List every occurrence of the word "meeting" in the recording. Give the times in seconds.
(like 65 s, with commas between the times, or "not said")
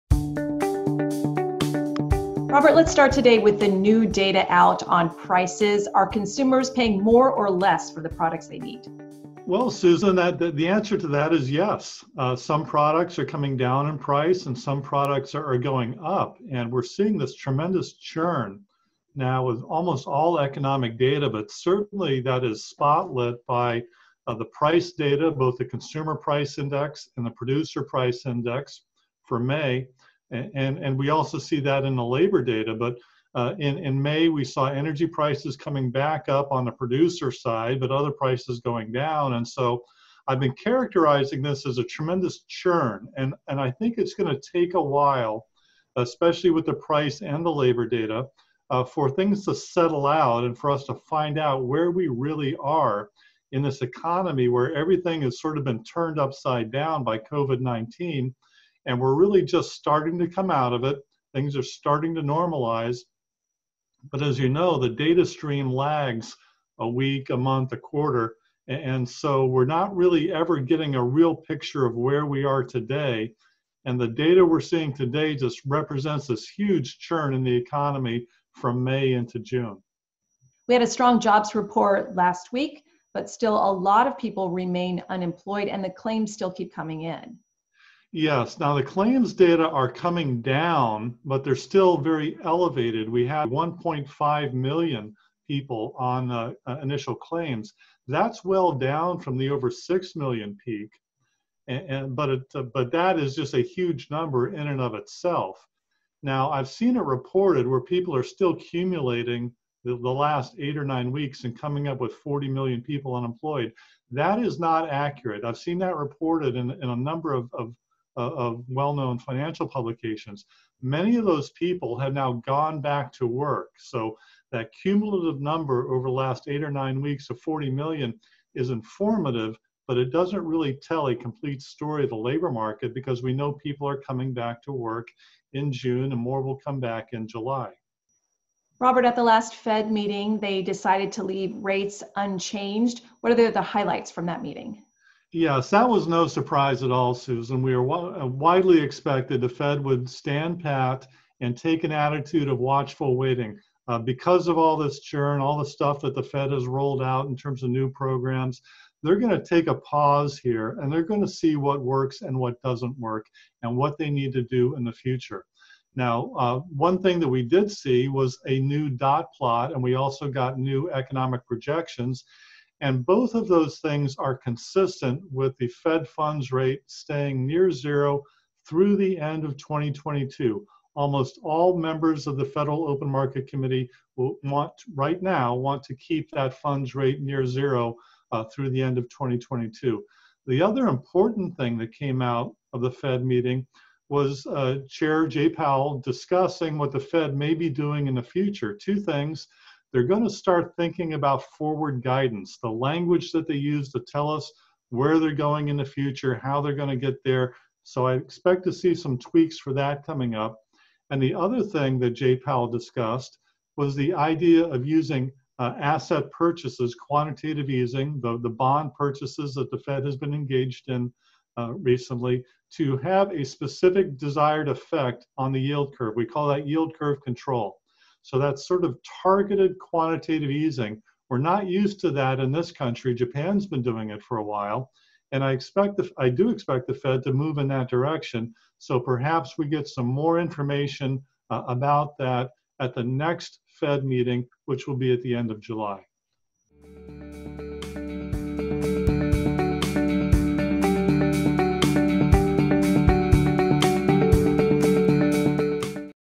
139 s, 144 s, 193 s, 244 s.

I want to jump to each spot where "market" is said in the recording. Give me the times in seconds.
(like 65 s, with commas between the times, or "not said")
132 s, 183 s.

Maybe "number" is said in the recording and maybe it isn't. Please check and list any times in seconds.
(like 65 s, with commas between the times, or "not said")
104 s, 116 s, 125 s.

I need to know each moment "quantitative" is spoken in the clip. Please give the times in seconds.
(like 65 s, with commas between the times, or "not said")
216 s, 229 s.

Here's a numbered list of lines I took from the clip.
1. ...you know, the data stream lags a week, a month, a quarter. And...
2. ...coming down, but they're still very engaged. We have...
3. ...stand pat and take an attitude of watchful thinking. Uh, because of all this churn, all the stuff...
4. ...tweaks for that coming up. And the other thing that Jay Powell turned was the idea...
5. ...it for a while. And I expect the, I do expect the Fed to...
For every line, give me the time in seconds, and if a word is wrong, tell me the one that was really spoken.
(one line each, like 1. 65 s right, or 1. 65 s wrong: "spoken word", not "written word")
1. 64 s right
2. 89 s wrong: "elevated", not "engaged"
3. 150 s wrong: "waiting", not "thinking"
4. 209 s wrong: "discussed", not "turned"
5. 234 s right.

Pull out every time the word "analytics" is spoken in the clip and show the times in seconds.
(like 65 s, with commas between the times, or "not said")
not said.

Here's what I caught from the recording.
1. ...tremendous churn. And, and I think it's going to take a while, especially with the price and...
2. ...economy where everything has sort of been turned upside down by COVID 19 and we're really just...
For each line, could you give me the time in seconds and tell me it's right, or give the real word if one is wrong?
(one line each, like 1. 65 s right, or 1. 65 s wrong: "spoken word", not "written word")
1. 41 s right
2. 53 s right.